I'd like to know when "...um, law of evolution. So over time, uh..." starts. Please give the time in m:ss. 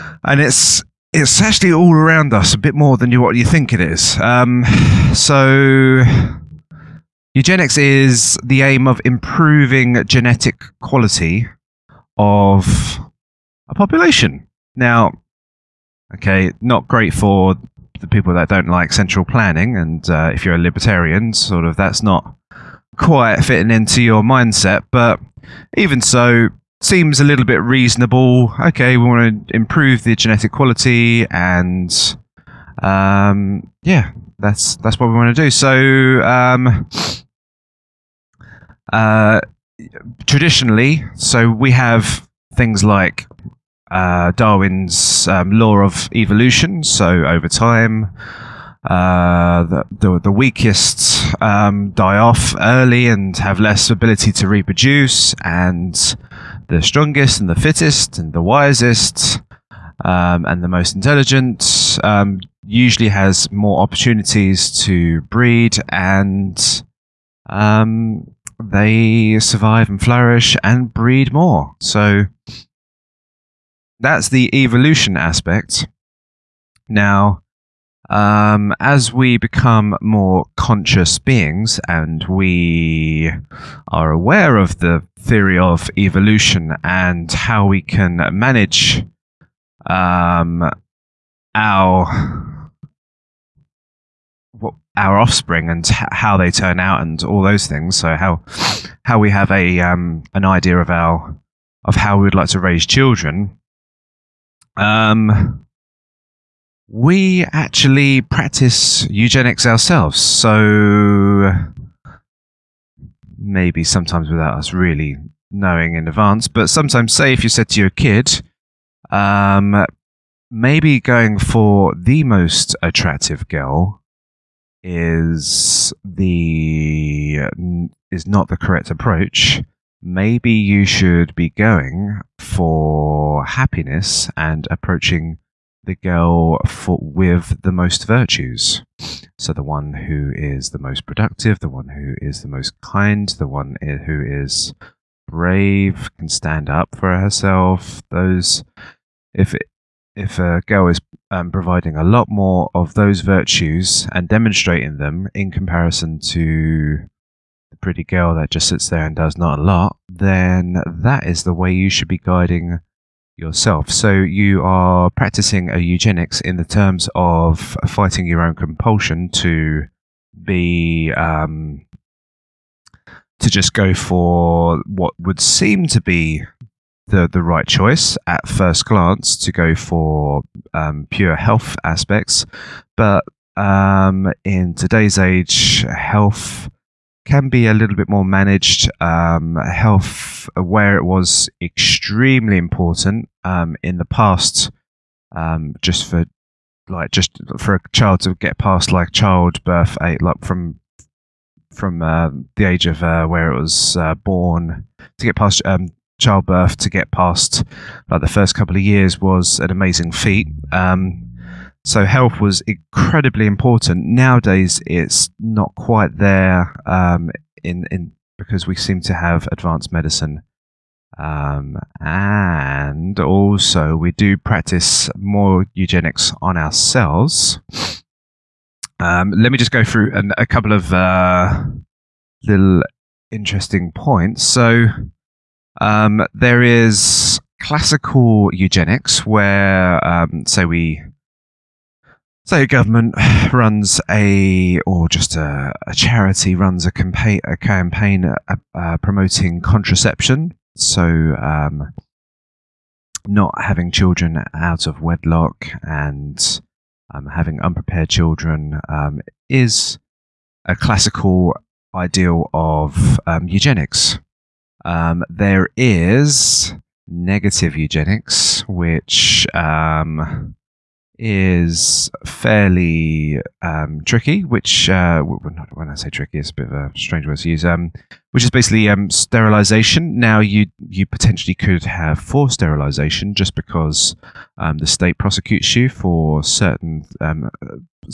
0:45.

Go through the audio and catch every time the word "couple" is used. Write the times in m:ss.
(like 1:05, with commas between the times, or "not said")
3:28, 3:50.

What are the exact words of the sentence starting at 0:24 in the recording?
But even so, seems a little bit reasonable.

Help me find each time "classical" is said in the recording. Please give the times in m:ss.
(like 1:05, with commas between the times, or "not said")
3:57, 4:20.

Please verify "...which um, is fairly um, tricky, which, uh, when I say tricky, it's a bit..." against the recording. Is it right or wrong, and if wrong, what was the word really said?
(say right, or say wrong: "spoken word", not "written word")
right.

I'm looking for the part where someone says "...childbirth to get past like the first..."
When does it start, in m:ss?
3:26.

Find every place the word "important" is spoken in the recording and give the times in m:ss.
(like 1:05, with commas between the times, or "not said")
3:12, 3:33.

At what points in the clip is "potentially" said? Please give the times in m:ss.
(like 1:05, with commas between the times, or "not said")
4:41.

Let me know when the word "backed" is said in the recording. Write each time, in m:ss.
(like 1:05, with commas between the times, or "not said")
not said.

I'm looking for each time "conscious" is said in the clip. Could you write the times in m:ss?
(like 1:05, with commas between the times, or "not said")
1:20.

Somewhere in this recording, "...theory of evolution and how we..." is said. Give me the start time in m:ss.
1:25.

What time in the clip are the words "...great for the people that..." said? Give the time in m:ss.
0:16.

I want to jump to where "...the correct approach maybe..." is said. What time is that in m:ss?
2:08.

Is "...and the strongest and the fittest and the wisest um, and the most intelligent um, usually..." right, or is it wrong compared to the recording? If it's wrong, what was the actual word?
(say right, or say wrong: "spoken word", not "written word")
right.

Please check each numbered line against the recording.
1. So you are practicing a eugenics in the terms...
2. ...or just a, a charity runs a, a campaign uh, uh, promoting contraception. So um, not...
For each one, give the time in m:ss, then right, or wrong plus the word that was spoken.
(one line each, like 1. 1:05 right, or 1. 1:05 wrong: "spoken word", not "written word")
1. 2:43 right
2. 4:04 right.